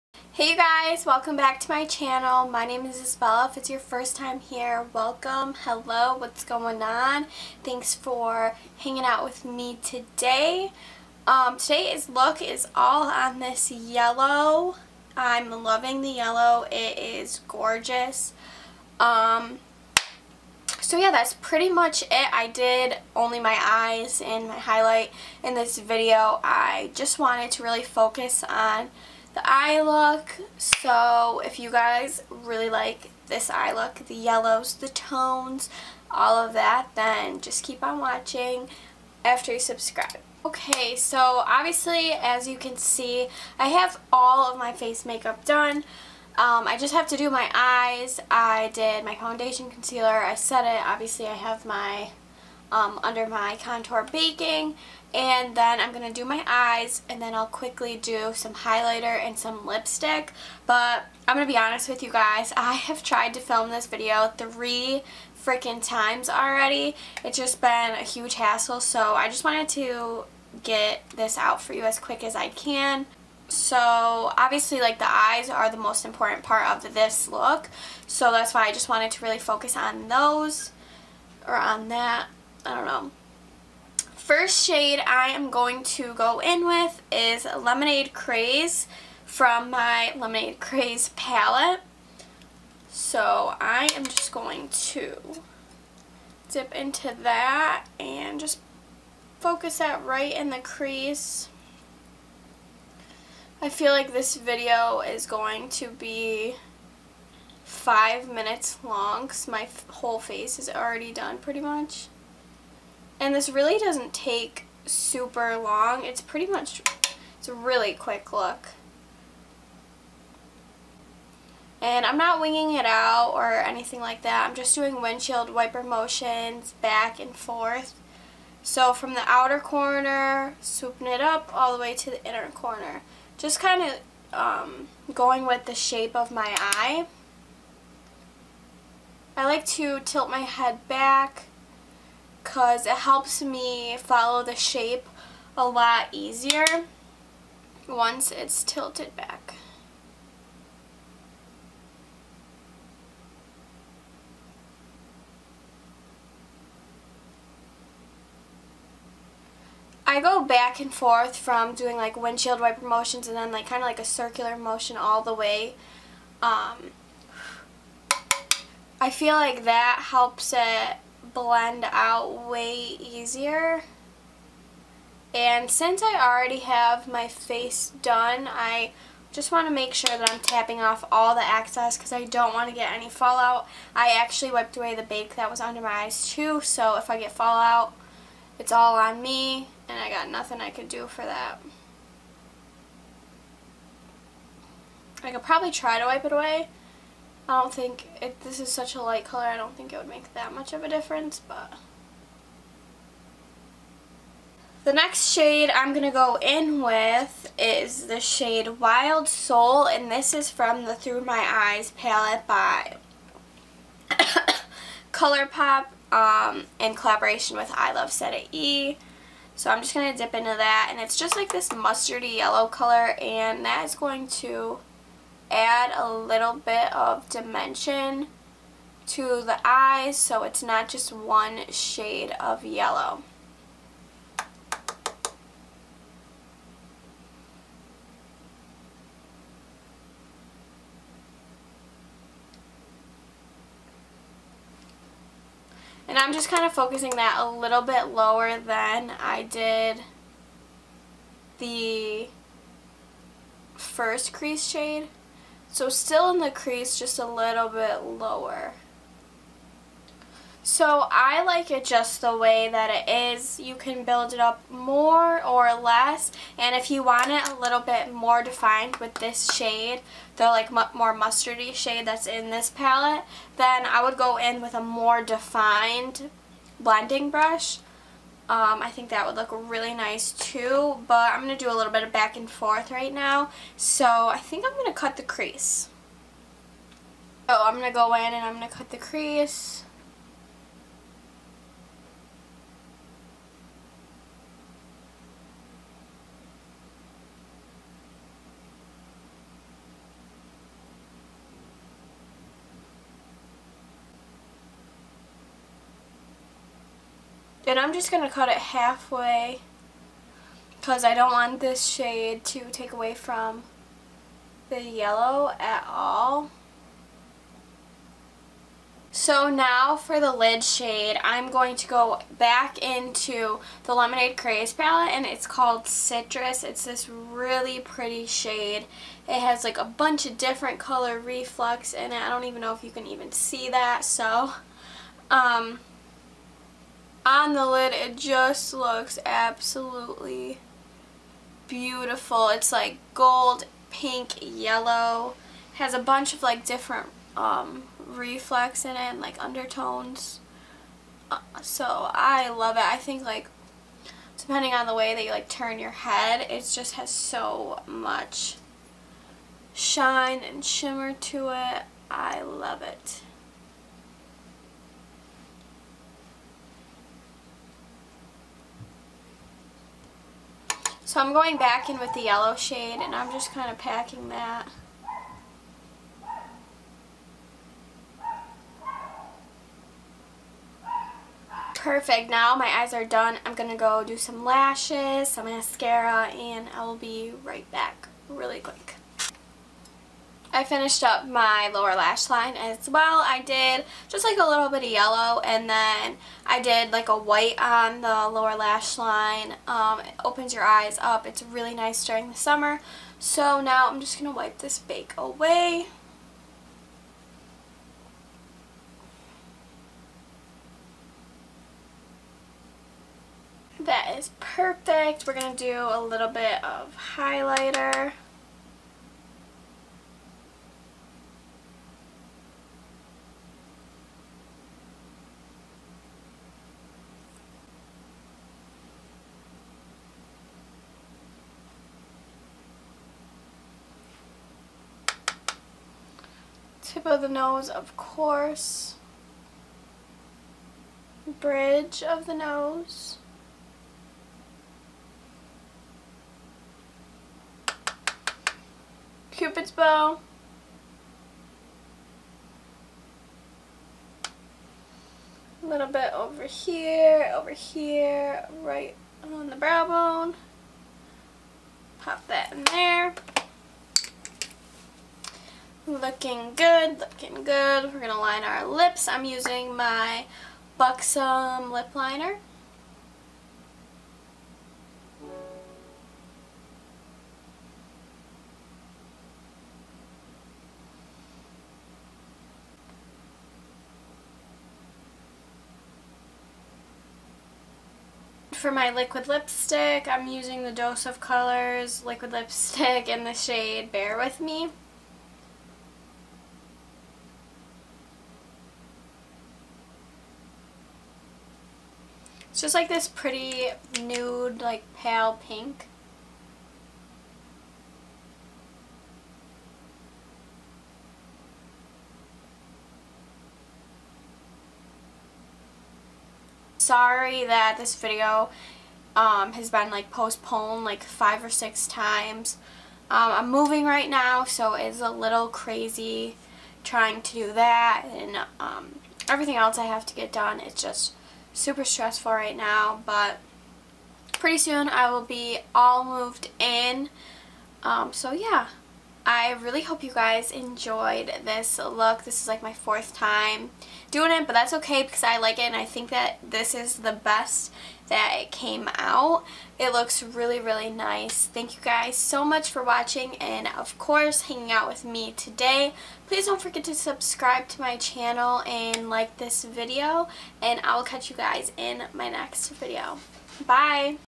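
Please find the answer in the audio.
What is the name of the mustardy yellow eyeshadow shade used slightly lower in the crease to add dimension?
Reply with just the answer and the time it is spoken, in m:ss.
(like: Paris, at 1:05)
Wild Soul, at 3:28.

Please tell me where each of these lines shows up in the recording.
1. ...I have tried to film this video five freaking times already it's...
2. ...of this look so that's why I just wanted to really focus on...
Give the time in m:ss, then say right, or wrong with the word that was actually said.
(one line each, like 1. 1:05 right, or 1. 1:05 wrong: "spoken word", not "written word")
1. 1:02 wrong: "three", not "five"
2. 1:16 right.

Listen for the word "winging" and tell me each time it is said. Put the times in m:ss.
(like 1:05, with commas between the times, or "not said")
2:02.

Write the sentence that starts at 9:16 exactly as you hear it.
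Please don't forget to subscribe to my channel and like this video, and I will catch you guys in my next video.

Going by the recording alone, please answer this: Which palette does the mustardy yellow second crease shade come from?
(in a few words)
Through My Eyes.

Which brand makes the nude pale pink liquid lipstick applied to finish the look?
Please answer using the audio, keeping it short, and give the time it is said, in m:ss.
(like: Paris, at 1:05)
Dose of Colors, at 8:10.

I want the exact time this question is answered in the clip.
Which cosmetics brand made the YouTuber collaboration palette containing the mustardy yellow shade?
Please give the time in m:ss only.
3:35.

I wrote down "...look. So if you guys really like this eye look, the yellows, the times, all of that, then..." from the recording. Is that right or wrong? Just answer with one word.
wrong.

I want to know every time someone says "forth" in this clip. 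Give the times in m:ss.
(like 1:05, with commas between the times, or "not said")
2:07, 2:40, 4:42.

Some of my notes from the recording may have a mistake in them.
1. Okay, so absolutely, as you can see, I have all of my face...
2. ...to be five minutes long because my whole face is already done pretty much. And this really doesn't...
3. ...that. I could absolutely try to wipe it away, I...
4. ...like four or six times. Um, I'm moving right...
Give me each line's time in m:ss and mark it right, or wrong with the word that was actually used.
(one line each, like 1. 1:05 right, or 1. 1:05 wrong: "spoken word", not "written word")
1. 0:40 wrong: "obviously", not "absolutely"
2. 1:45 right
3. 3:11 wrong: "probably", not "absolutely"
4. 8:40 wrong: "five", not "four".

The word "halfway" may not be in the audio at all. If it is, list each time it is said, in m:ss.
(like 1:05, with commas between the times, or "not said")
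5:08.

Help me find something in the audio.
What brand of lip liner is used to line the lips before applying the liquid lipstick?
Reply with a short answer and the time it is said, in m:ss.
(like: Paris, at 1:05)
Buxom, at 7:50.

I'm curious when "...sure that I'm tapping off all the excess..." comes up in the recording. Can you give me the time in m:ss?
2:59.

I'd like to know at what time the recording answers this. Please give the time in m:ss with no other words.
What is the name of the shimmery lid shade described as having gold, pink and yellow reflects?
5:25.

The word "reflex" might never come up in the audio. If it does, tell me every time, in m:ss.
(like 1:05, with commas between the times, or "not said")
5:31, 5:47.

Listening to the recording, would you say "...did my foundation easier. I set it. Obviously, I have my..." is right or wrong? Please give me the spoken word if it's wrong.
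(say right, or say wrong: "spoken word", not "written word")
wrong: "concealer", not "easier".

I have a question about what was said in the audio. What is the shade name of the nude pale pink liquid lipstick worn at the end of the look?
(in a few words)
Bear With Me.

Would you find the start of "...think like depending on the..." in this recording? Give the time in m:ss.
5:52.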